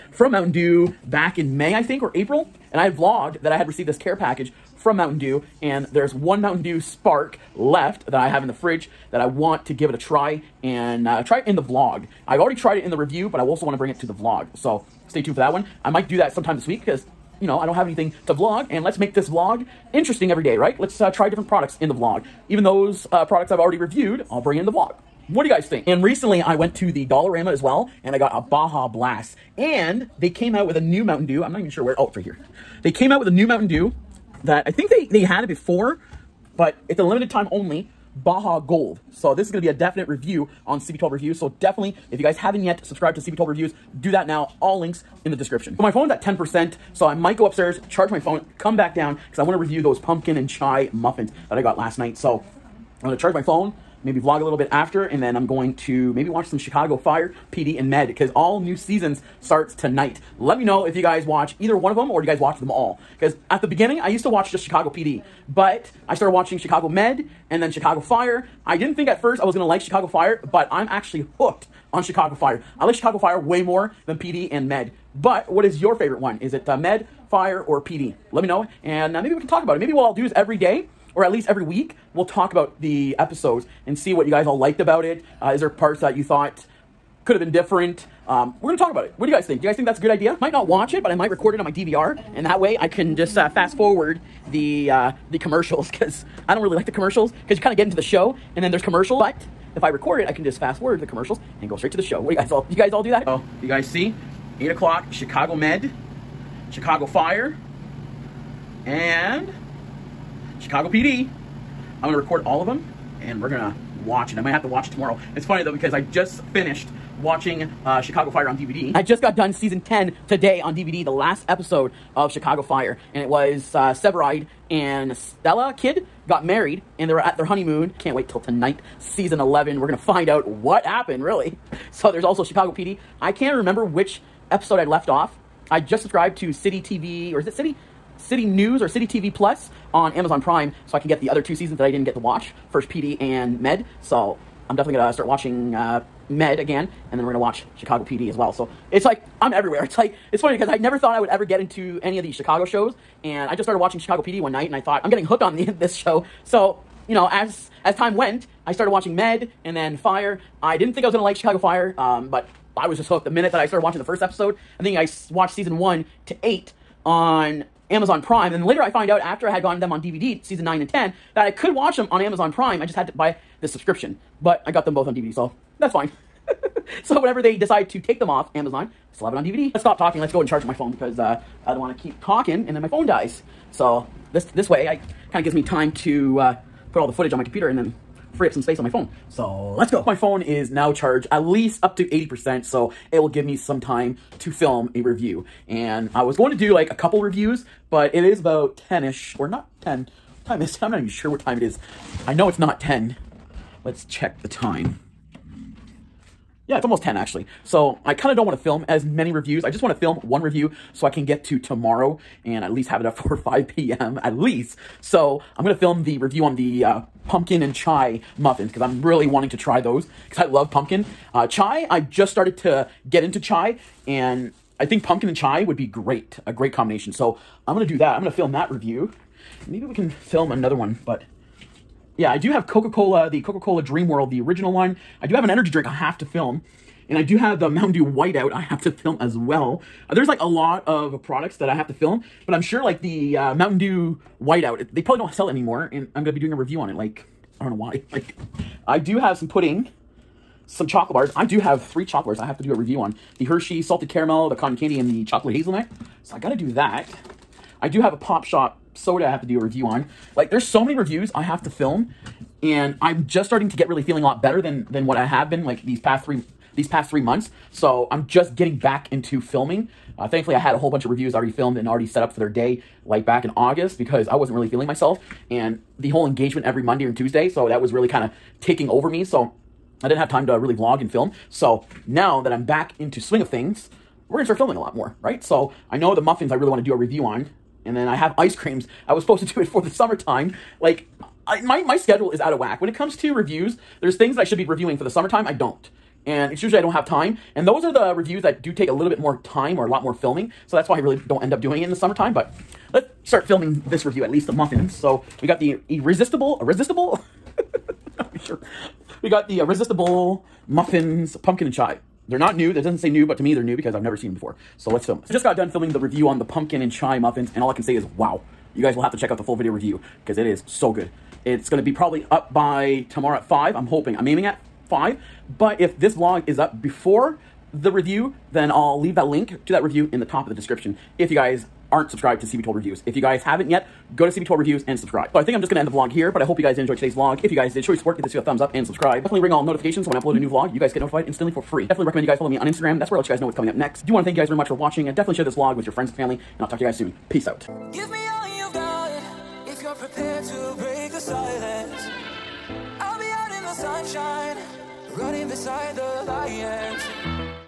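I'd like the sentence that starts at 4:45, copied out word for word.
So I know the muffins I really want to do a review on.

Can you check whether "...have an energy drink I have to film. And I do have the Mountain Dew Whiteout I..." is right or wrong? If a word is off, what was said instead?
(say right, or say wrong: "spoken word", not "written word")
right.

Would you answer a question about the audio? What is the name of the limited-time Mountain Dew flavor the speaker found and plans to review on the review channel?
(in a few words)
Baja Gold.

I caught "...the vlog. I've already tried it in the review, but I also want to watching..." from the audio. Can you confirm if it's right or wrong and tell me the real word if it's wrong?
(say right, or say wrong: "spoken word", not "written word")
wrong: "bring", not "watching".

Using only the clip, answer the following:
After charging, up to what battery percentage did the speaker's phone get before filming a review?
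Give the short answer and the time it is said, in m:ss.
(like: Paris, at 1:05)
80%, at 3:12.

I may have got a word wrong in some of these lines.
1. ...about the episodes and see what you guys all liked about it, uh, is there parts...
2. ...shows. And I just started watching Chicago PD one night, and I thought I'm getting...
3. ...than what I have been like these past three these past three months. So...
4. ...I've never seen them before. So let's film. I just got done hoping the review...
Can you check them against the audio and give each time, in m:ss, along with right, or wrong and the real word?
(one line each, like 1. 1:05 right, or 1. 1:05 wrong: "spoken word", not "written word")
1. 1:22 right
2. 2:32 right
3. 4:24 right
4. 5:13 wrong: "filming", not "hoping".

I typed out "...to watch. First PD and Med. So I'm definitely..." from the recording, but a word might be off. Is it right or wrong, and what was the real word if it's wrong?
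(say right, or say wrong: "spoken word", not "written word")
right.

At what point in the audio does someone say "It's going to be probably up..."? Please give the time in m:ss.
5:21.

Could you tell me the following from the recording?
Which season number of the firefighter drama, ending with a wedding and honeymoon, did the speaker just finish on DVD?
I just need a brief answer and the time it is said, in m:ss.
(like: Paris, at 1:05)
10, at 1:59.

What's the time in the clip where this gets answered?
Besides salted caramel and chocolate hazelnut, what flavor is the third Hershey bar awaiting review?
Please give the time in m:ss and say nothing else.
4:14.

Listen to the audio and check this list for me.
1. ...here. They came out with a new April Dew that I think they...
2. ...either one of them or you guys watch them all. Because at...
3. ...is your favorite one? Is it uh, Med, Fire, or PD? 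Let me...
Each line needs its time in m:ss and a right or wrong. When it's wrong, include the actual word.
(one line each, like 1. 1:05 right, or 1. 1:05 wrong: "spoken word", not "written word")
1. 0:32 wrong: "Mountain", not "April"
2. 1:01 right
3. 1:15 right.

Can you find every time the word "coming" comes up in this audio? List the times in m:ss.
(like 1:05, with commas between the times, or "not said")
5:43.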